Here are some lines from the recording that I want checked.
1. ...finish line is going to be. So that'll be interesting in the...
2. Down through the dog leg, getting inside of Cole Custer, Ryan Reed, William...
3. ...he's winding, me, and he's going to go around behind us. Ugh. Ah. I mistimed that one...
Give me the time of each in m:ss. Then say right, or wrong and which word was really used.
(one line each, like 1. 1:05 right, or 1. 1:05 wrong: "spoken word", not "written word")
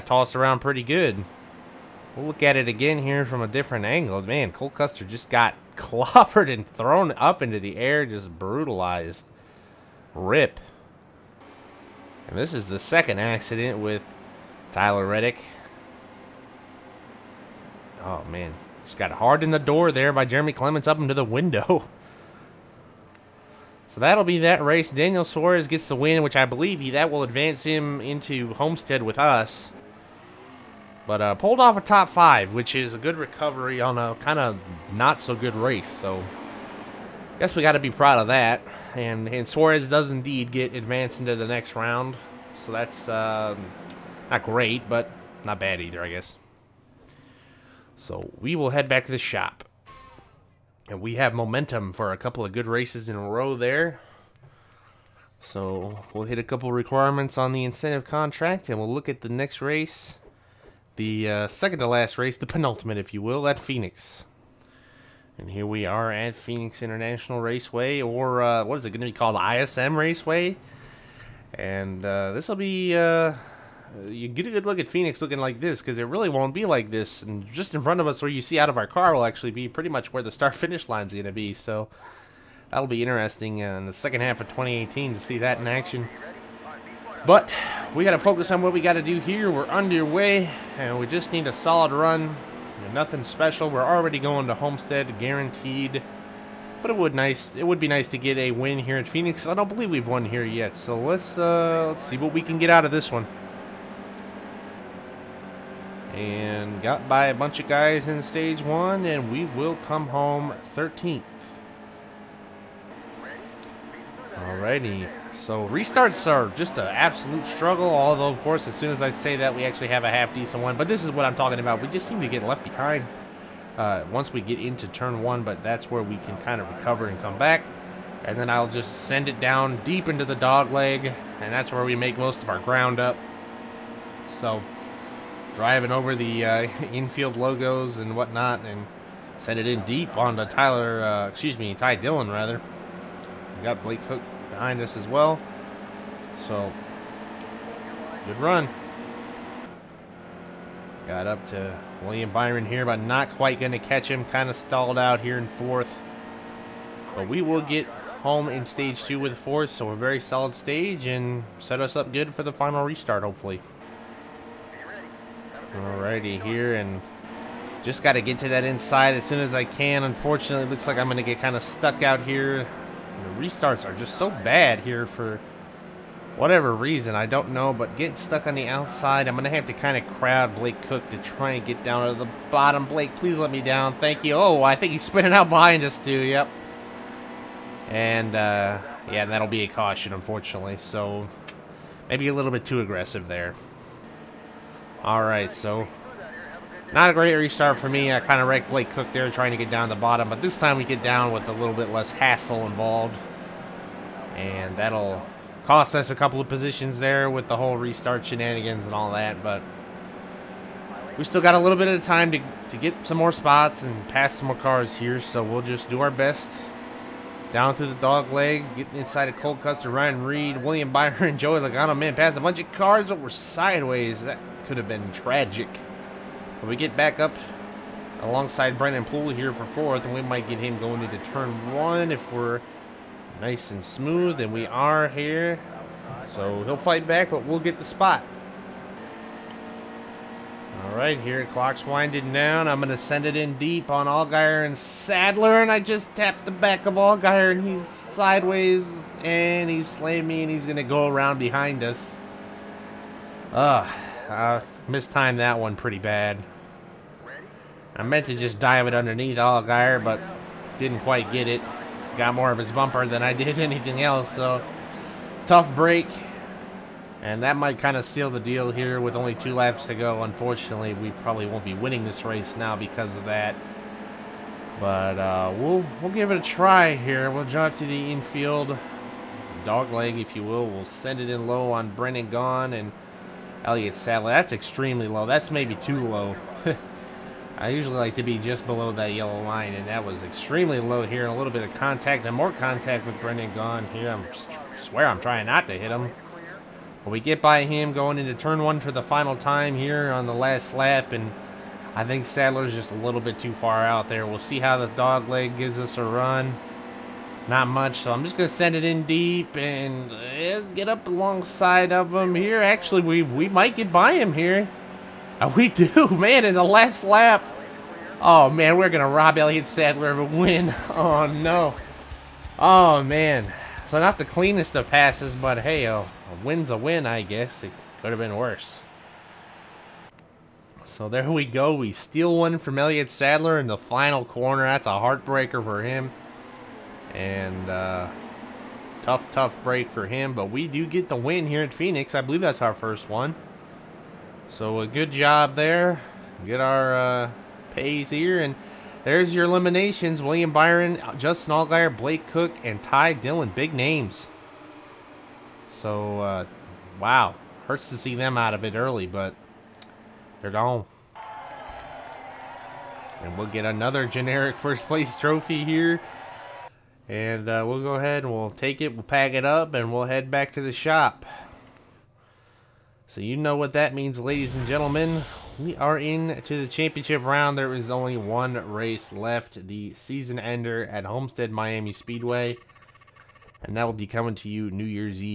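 1. 1:20 right
2. 3:37 right
3. 4:09 wrong: "slamming", not "winding".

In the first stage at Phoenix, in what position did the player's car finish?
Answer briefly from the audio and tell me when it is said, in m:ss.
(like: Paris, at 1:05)
13th, at 1:50.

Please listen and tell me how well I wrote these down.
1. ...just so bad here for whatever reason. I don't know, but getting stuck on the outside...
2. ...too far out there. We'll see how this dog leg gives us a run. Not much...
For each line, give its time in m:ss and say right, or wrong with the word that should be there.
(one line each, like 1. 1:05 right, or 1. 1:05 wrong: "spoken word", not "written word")
1. 2:53 right
2. 5:03 right.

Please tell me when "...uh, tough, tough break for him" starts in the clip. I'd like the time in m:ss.
5:37.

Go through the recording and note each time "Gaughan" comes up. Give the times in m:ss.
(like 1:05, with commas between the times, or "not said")
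4:42, 4:53.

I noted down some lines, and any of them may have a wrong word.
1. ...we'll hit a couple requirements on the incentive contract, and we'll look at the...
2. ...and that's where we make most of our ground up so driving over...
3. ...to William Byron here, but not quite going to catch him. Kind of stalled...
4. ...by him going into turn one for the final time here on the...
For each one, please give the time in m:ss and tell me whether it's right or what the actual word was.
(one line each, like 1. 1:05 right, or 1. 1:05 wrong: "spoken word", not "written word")
1. 0:56 right
2. 2:11 right
3. 2:31 right
4. 4:57 right.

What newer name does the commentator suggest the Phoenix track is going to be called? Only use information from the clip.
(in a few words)
ISM Raceway.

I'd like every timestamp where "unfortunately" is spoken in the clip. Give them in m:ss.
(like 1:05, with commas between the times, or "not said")
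2:50, 3:10, 4:30.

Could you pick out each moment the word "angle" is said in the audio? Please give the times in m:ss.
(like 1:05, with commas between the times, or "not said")
0:03.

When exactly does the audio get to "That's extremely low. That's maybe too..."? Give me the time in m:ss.
4:44.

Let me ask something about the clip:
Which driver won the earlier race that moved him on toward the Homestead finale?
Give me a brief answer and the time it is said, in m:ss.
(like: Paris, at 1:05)
Daniel Suarez, at 0:24.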